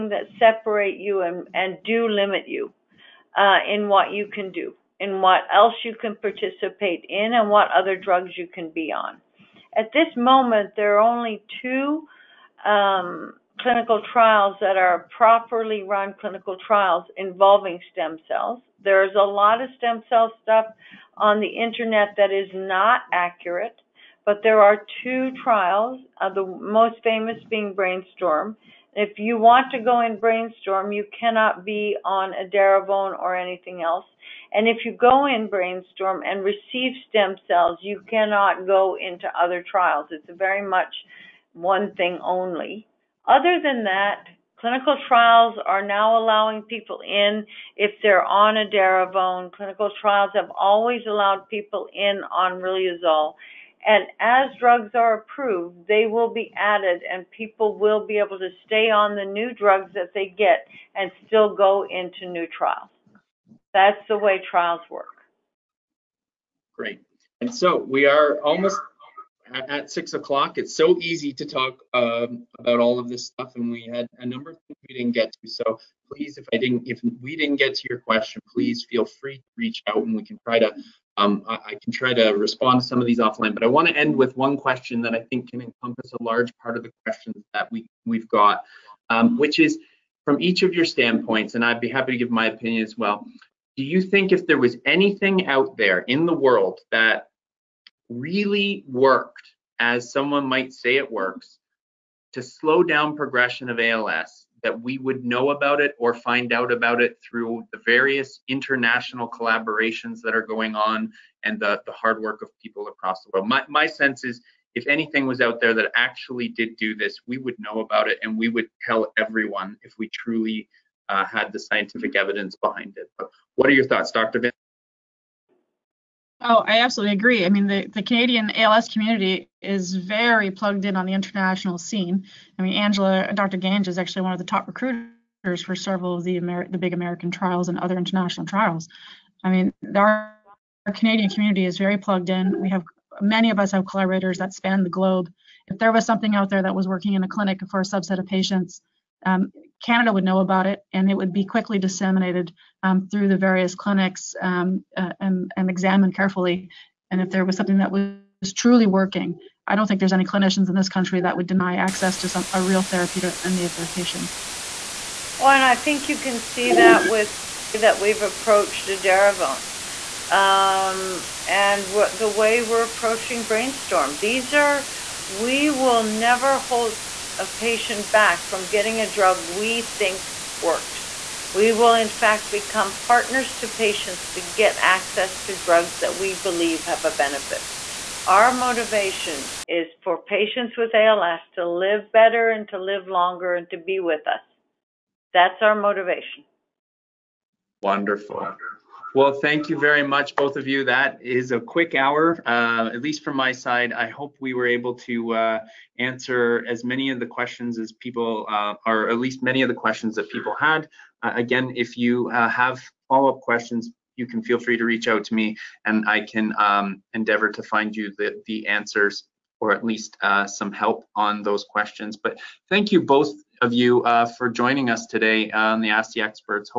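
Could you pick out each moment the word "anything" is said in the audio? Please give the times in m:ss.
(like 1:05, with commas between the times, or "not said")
0:33, 1:34, 1:54.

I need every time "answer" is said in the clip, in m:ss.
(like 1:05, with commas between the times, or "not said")
3:25, 3:38.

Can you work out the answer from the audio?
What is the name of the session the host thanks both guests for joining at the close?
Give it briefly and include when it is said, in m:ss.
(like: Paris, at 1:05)
Ask the Experts, at 3:45.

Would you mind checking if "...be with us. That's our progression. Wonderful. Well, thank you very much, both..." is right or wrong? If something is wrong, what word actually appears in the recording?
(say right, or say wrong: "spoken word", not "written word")
wrong: "motivation", not "progression".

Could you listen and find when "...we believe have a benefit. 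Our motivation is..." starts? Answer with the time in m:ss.
3:06.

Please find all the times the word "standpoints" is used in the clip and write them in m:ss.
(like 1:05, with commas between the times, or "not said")
1:30.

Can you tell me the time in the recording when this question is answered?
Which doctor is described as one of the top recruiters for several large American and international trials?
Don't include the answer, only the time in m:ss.
2:13.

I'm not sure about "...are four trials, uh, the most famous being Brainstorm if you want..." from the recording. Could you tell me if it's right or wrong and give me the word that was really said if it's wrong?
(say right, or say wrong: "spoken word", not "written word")
wrong: "two", not "four".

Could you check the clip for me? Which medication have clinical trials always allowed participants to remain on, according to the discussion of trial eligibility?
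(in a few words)
Riluzole.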